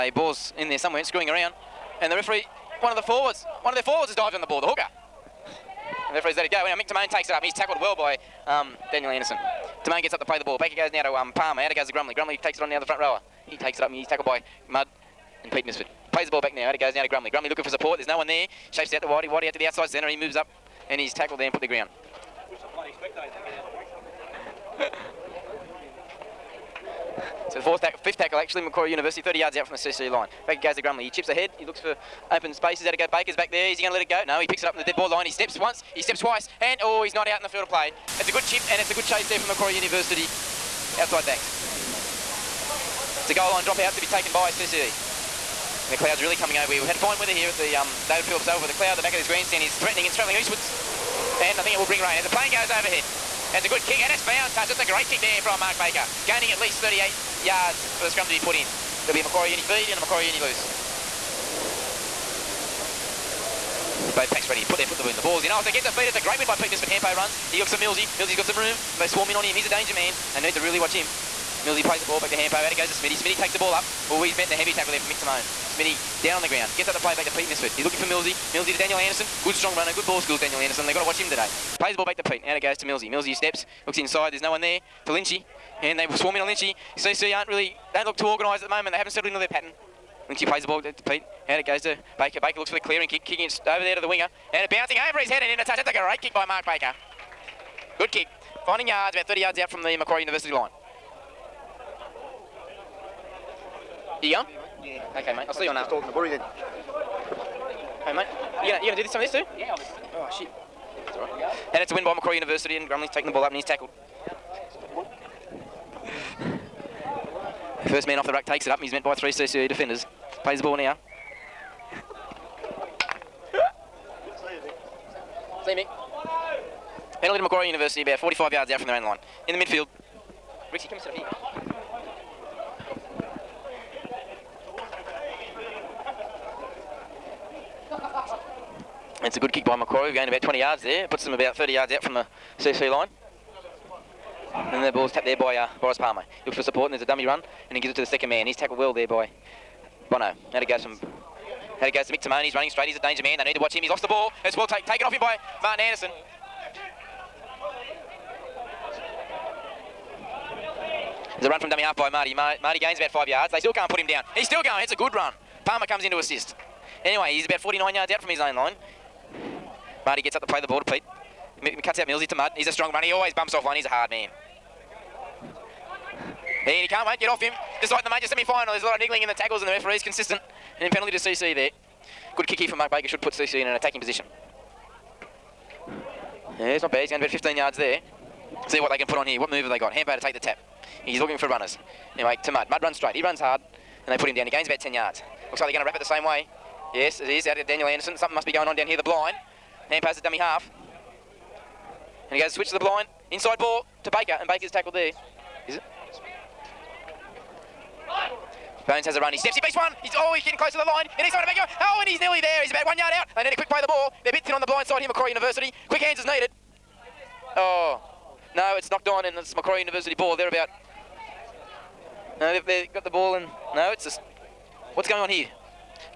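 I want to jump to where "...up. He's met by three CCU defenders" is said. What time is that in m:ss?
1:58.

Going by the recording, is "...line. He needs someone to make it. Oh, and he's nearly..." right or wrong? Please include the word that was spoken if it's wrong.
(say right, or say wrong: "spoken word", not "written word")
right.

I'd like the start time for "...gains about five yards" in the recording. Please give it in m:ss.
2:42.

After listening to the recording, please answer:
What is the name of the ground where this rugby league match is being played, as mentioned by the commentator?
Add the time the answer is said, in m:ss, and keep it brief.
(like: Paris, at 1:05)
David Phillips Oval, at 0:48.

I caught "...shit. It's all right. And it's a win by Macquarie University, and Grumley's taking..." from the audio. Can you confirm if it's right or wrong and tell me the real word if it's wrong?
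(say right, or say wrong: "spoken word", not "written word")
right.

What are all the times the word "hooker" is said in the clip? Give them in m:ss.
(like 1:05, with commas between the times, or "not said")
0:04.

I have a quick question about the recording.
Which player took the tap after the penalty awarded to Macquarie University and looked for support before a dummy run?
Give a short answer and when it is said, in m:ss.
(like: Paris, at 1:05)
Boris Palmer, at 2:25.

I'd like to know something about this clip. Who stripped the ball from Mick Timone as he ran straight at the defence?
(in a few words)
Martin Anderson.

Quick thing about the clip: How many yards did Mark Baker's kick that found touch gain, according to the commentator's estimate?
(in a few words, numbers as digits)
38.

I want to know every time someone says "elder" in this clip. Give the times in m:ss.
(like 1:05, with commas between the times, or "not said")
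not said.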